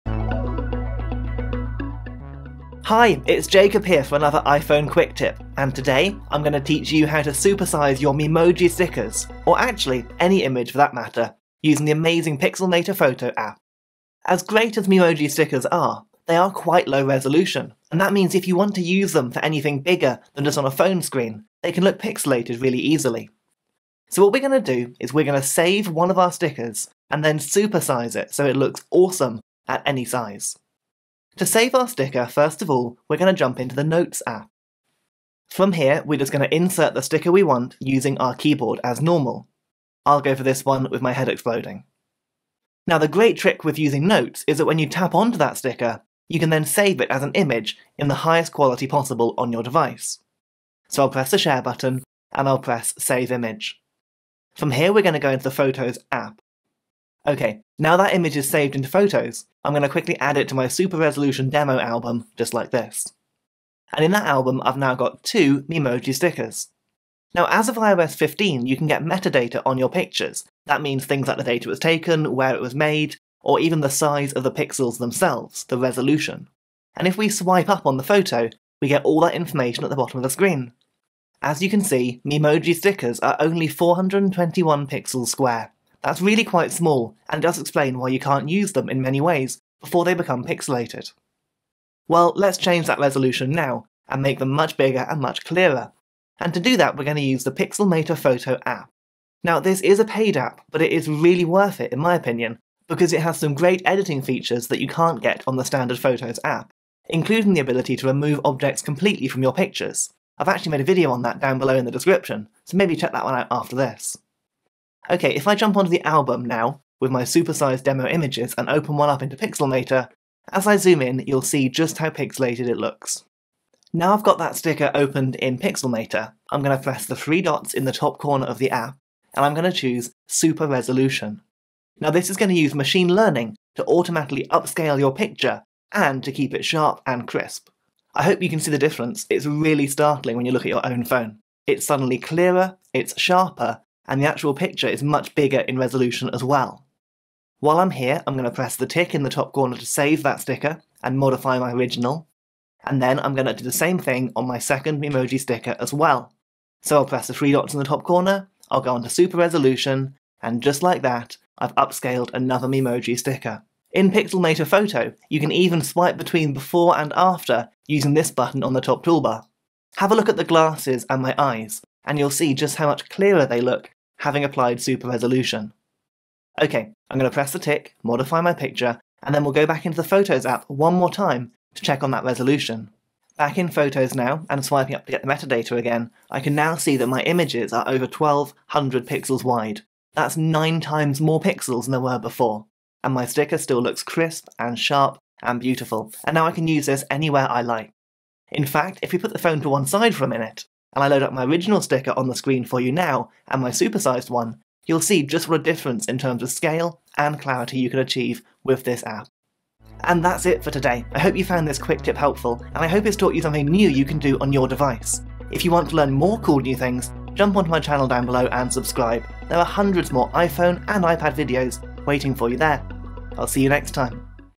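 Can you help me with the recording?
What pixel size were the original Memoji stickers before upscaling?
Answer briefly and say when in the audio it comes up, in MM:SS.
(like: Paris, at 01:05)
421 pixels square, at 01:23.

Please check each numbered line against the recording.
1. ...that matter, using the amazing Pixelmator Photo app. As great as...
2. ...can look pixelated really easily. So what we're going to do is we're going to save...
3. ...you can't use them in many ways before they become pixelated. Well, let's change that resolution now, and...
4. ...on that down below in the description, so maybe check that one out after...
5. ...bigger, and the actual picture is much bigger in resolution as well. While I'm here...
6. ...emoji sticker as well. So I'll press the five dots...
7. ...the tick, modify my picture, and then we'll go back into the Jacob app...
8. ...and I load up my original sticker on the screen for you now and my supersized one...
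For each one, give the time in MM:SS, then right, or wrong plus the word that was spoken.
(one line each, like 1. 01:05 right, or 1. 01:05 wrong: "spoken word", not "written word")
1. 00:10 right
2. 00:21 right
3. 01:28 right
4. 01:51 right
5. 02:23 wrong: "sharper", not "bigger"
6. 02:35 wrong: "three", not "five"
7. 02:57 wrong: "Photos", not "Jacob"
8. 03:20 right.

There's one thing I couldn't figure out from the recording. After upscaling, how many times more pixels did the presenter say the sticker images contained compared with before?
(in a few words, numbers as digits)
9 times.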